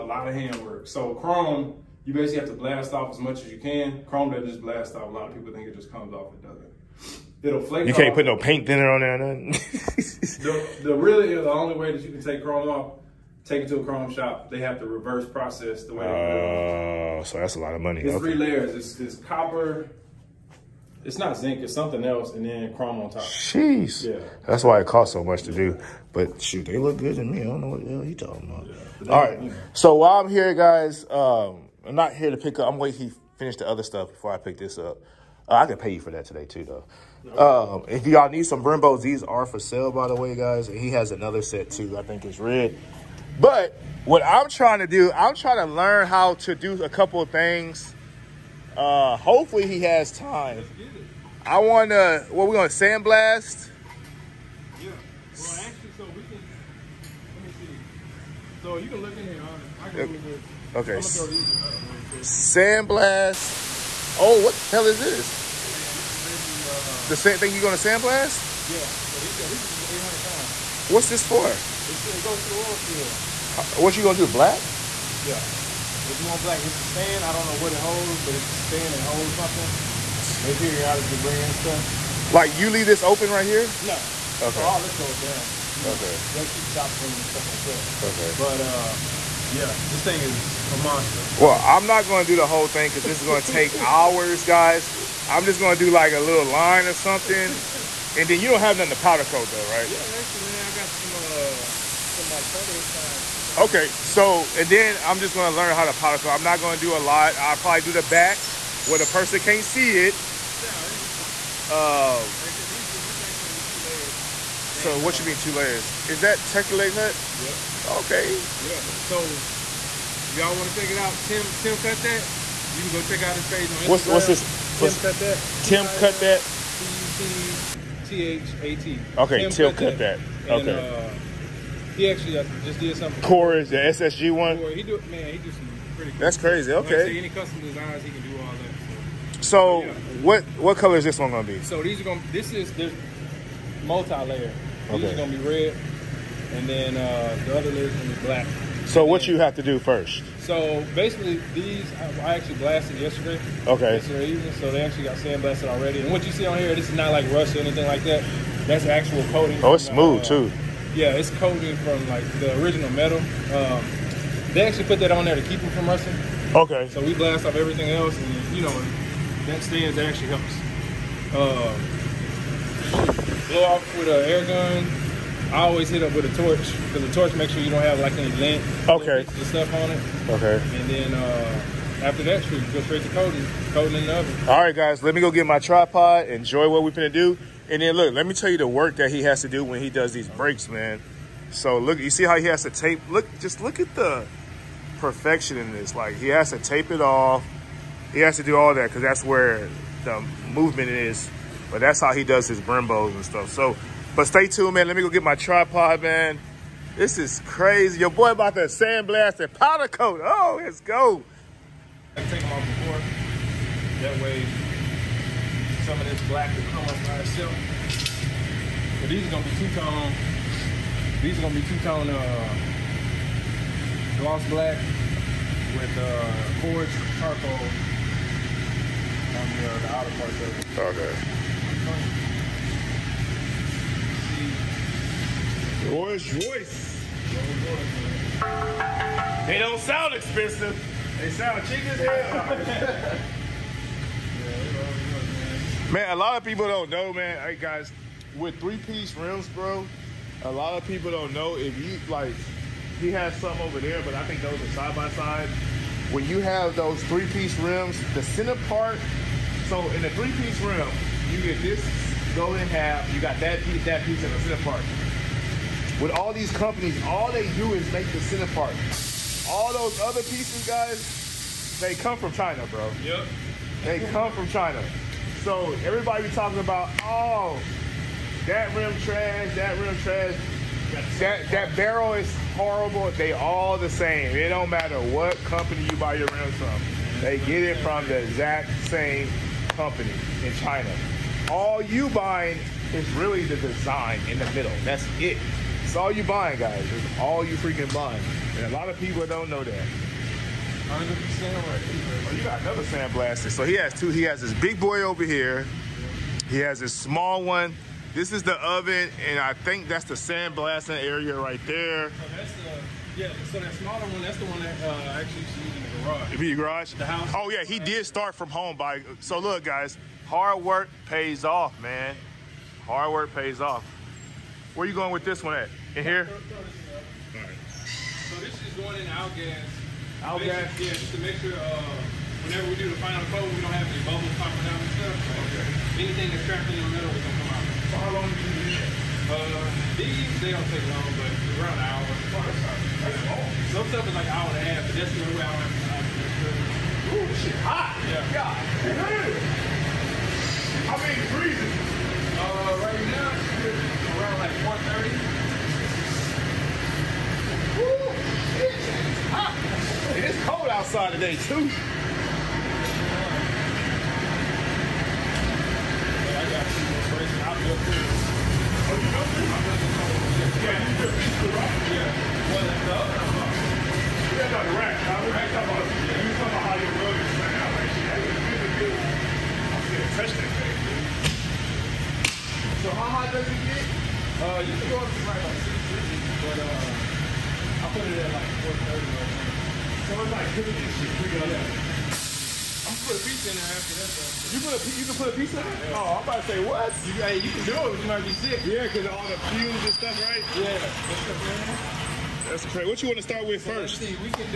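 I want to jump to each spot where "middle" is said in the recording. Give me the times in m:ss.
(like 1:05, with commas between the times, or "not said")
4:54.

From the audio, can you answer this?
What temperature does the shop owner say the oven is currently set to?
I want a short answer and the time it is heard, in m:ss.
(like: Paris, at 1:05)
430, at 6:28.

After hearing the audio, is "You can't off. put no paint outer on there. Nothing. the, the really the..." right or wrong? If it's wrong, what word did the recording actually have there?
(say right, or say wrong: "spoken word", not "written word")
wrong: "thinner", not "outer".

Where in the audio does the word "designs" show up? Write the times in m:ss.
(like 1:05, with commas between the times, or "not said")
2:17, 4:53.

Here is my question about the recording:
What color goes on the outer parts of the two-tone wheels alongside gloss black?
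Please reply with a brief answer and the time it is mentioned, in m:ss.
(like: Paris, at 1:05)
Forged charcoal, at 3:46.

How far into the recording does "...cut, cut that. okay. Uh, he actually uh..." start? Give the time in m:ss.
2:09.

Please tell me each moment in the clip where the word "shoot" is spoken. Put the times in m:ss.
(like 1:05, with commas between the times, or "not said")
0:26, 3:02.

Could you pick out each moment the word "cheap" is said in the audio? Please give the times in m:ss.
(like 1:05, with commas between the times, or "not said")
4:01.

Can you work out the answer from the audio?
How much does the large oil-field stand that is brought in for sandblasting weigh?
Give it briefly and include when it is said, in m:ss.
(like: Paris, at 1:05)
800 pounds, at 1:09.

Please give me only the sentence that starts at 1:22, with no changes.
Like you leave this open right here?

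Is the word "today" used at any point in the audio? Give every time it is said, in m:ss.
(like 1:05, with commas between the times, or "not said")
0:36, 6:01.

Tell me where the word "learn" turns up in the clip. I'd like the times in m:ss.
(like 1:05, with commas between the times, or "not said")
0:45, 1:45.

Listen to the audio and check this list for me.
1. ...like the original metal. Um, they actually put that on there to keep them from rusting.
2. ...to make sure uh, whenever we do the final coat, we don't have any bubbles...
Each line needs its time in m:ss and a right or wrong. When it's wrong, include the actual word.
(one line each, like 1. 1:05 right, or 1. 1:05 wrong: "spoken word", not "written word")
1. 2:42 right
2. 5:31 right.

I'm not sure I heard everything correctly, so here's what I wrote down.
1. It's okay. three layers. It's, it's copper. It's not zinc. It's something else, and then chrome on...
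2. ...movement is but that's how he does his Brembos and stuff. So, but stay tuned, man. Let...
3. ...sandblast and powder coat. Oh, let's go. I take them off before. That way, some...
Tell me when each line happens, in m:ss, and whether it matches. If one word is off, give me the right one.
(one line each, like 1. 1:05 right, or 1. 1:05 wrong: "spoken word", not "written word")
1. 0:18 right
2. 3:20 right
3. 3:28 right.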